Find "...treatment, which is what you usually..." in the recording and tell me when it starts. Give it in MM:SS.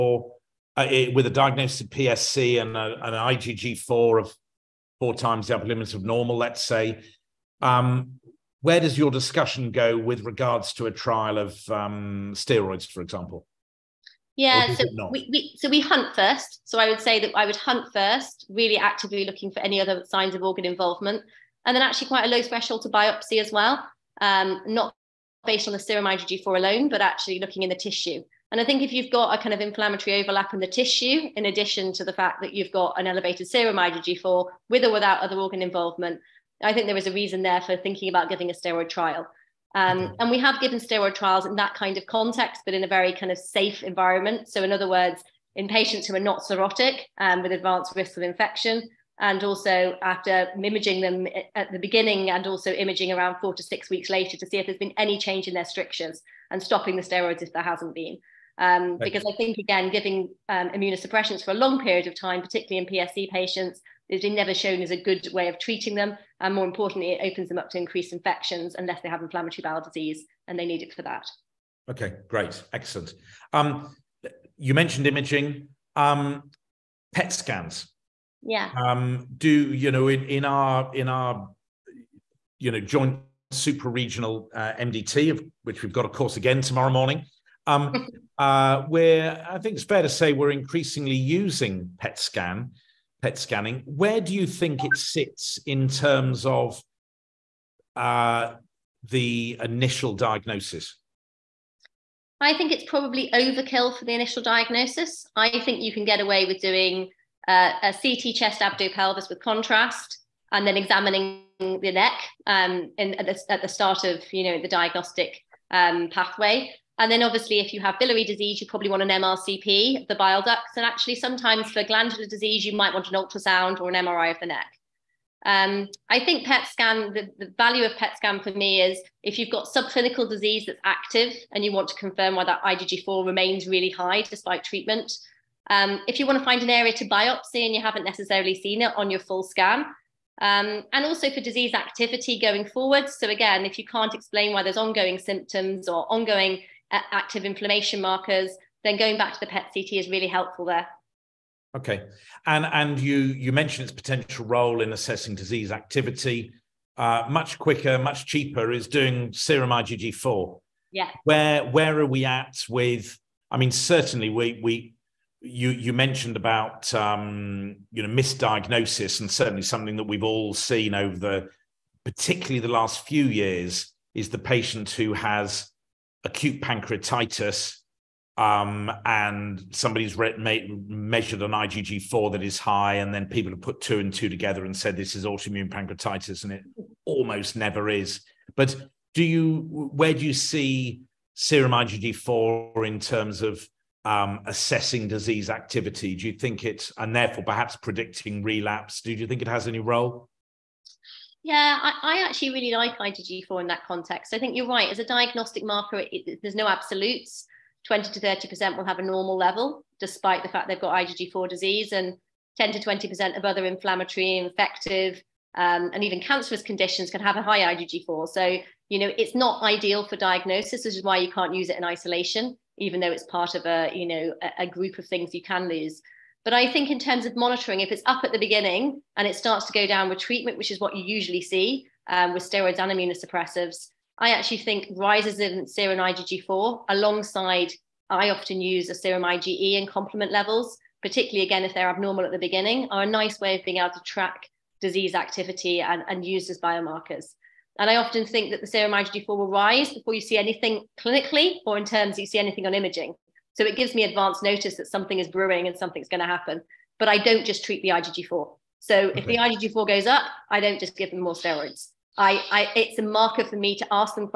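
03:50.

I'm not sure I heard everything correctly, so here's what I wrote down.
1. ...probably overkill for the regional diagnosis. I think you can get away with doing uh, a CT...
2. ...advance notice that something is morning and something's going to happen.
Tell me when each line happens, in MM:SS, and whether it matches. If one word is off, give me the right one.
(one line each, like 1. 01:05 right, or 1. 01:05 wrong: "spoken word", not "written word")
1. 01:42 wrong: "initial", not "regional"
2. 04:14 wrong: "brewing", not "morning".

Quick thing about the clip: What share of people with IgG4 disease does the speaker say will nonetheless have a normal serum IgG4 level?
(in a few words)
20 to 30%.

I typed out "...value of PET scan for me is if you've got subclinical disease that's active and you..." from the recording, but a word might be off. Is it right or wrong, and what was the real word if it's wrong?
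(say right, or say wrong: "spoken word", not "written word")
right.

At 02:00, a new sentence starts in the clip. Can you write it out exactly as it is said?
And actually, sometimes for glandular disease, you might want an ultrasound or an MRI of the neck.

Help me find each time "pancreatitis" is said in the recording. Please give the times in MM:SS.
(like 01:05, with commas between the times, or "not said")
02:56, 03:05.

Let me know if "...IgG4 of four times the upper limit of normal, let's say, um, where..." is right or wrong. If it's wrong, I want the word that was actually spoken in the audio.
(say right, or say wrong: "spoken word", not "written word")
right.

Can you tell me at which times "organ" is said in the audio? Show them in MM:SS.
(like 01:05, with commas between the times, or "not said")
00:20, 00:35.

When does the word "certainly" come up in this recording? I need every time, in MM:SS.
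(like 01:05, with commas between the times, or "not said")
02:43, 02:49.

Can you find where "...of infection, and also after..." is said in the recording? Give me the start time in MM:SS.
00:48.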